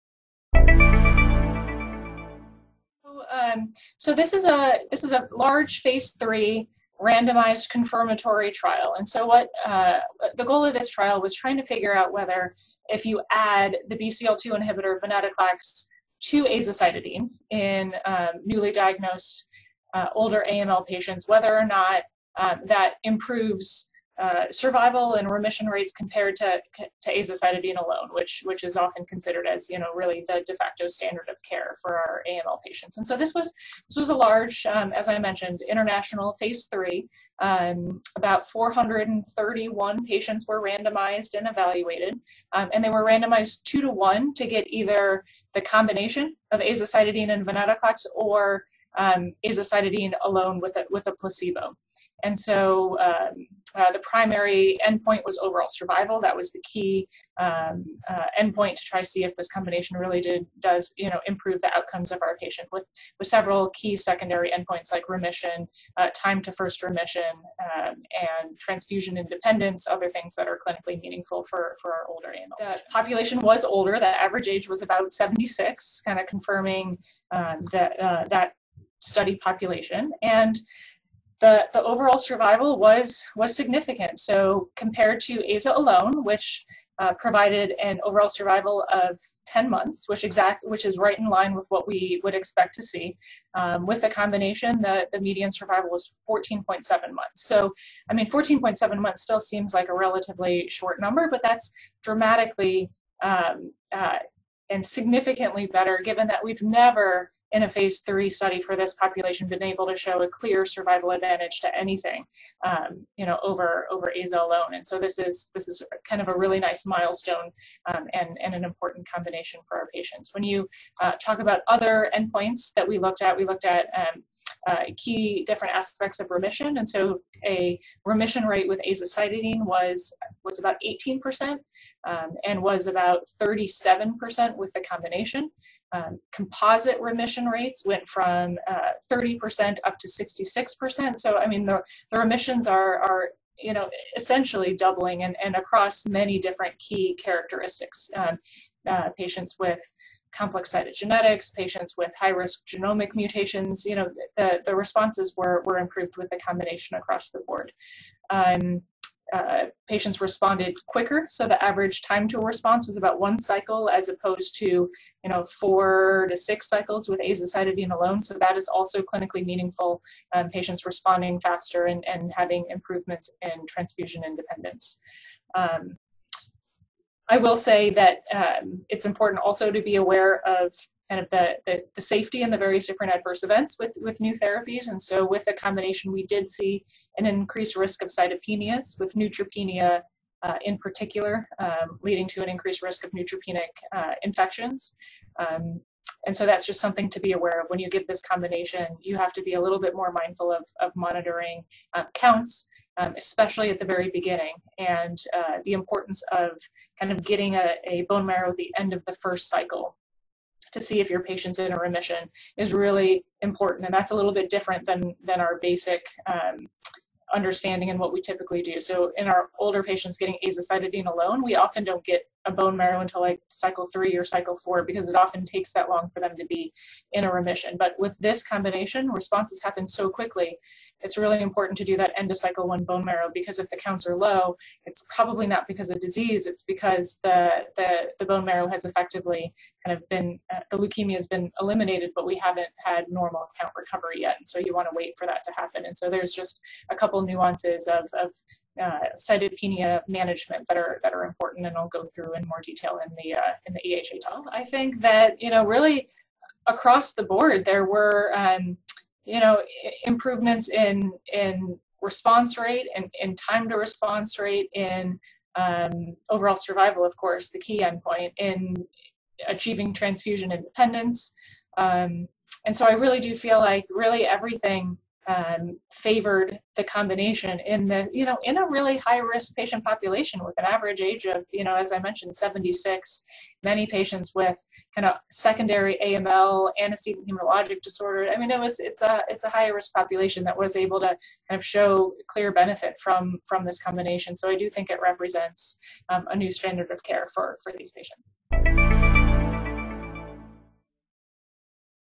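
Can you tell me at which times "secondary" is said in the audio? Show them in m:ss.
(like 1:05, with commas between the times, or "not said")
1:03, 4:45.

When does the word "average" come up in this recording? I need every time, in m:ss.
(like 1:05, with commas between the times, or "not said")
1:14, 2:41, 4:40.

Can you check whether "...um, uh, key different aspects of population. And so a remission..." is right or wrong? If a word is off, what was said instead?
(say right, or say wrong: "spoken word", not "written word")
wrong: "remission", not "population".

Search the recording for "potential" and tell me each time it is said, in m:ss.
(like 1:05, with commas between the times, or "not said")
not said.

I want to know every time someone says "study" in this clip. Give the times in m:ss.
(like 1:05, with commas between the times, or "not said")
1:18, 1:48.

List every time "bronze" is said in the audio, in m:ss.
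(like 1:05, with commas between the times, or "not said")
not said.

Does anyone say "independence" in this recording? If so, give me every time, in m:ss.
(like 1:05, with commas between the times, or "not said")
1:09, 2:54, 4:30.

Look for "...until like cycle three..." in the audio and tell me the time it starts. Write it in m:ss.
3:43.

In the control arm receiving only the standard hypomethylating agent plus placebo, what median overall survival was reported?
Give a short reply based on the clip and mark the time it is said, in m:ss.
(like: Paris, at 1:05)
10 months, at 1:29.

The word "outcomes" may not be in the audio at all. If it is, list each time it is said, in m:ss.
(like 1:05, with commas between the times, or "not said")
1:01.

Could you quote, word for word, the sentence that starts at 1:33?
Um, with the combination, the, the median survival was 14.7 months.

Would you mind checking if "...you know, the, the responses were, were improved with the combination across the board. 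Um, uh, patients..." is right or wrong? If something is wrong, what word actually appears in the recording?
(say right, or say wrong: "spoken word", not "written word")
right.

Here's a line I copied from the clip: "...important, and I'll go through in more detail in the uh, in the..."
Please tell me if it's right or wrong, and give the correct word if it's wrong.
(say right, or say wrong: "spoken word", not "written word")
right.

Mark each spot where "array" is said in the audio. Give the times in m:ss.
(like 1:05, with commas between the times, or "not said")
not said.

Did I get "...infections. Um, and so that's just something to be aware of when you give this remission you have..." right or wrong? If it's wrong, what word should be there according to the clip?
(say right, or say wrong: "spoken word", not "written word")
wrong: "combination", not "remission".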